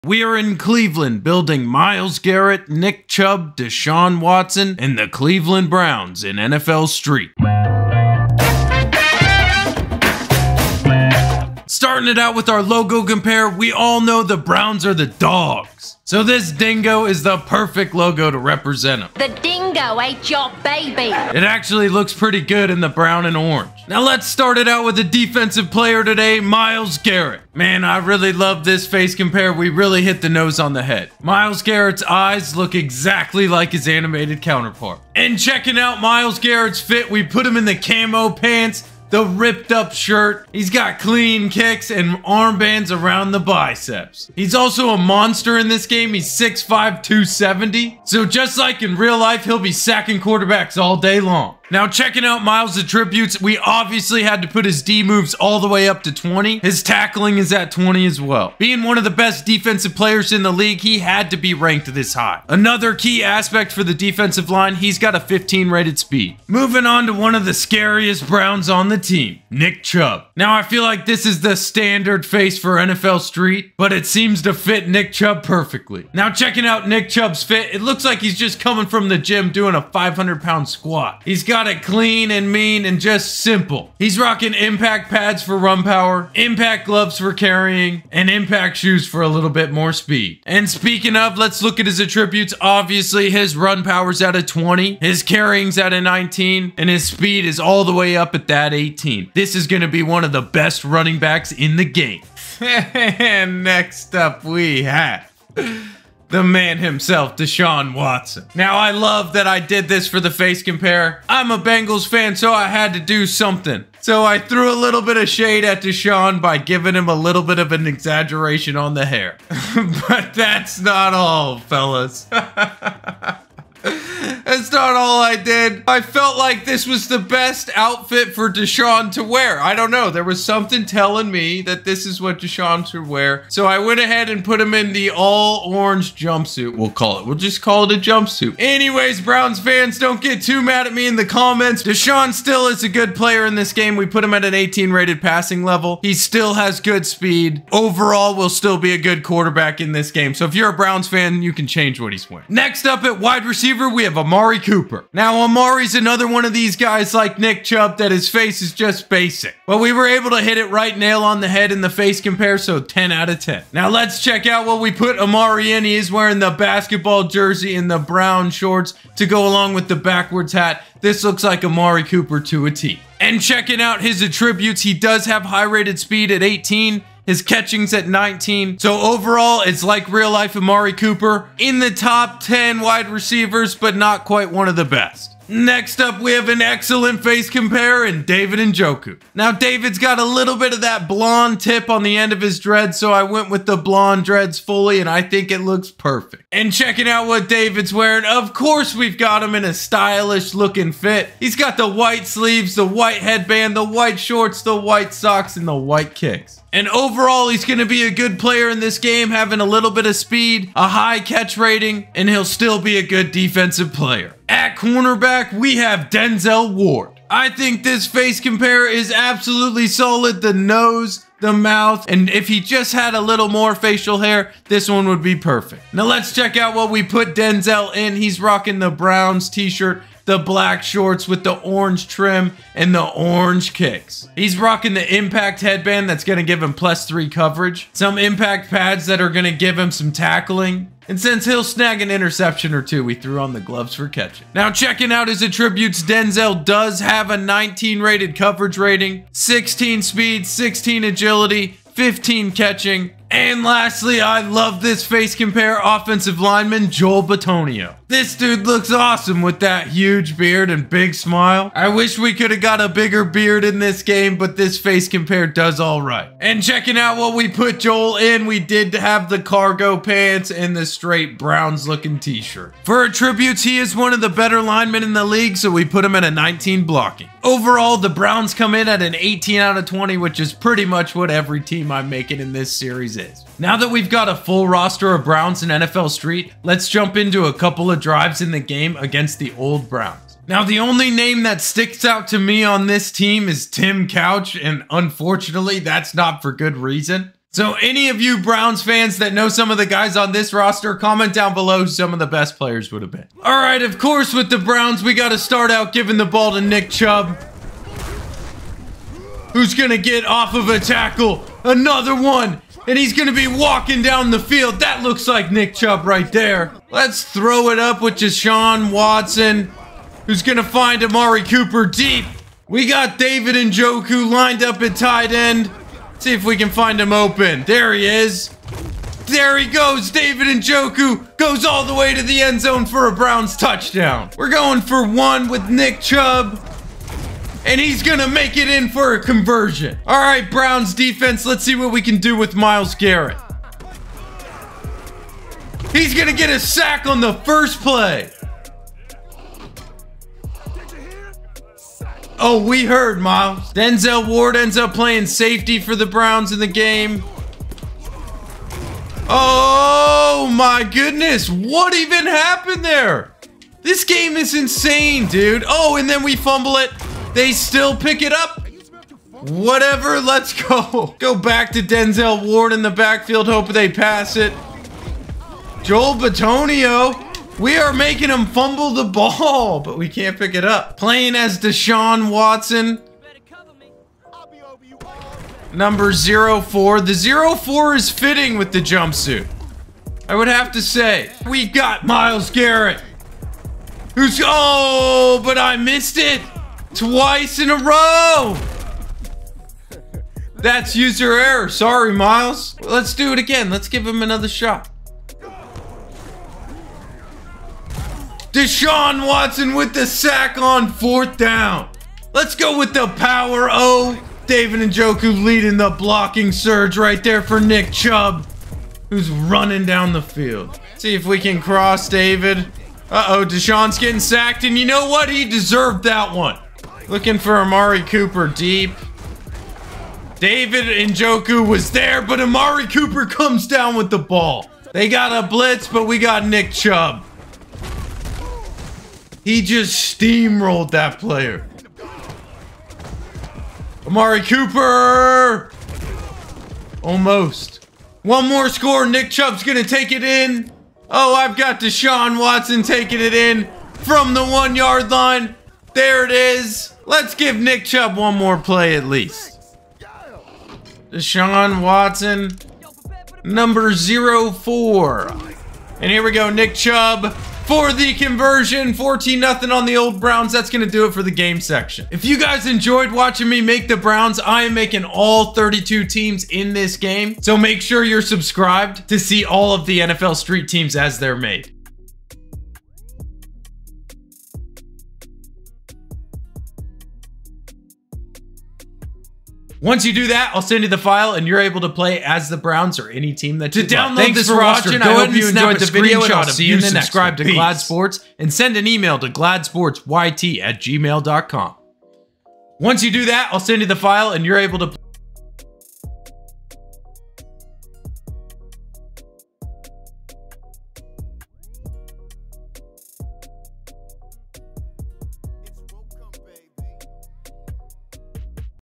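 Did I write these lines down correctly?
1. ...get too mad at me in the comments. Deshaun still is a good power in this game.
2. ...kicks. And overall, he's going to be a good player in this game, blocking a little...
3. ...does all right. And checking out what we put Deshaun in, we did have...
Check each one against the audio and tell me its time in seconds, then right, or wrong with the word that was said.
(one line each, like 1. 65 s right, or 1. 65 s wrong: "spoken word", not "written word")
1. 140 s wrong: "player", not "power"
2. 206 s wrong: "having", not "blocking"
3. 265 s wrong: "Joel", not "Deshaun".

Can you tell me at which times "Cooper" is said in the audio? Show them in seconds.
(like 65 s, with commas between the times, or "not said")
154 s, 172 s, 180 s, 321 s, 428 s, 432 s, 444 s.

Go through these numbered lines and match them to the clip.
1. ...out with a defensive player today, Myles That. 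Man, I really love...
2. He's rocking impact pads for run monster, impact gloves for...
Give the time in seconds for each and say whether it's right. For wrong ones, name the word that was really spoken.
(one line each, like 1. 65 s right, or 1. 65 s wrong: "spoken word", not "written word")
1. 24 s wrong: "Garrett", not "That"
2. 83 s wrong: "power", not "monster".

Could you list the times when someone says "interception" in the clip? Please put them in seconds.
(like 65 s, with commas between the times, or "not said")
242 s.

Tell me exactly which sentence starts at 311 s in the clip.
Another one and he's gonna be walking down the field.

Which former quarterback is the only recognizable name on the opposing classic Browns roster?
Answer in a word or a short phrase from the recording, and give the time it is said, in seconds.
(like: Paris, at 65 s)
Tim Couch, at 293 s.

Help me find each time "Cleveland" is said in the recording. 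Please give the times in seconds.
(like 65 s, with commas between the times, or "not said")
0 s, 5 s.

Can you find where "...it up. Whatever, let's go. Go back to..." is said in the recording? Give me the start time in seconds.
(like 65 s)
368 s.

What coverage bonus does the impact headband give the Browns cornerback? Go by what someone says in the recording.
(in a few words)
Plus 3.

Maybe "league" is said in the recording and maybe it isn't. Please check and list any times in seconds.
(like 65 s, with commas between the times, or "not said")
60 s, 275 s.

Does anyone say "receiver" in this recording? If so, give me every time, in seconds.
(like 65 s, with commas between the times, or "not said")
153 s, 183 s.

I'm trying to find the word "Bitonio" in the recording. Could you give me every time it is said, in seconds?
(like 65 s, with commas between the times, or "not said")
257 s, 376 s.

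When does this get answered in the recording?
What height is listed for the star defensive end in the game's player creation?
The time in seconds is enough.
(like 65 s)
46 s.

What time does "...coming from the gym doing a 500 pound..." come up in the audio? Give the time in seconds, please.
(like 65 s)
78 s.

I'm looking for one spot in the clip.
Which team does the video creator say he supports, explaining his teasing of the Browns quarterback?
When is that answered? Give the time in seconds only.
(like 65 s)
111 s.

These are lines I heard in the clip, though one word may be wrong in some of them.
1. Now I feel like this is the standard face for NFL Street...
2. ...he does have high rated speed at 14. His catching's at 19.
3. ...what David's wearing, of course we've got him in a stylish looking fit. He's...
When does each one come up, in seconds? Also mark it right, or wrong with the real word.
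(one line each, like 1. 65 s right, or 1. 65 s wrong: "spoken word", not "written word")
1. 70 s right
2. 174 s wrong: "18", not "14"
3. 197 s right.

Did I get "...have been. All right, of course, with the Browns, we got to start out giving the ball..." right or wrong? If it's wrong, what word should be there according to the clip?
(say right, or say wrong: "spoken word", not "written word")
right.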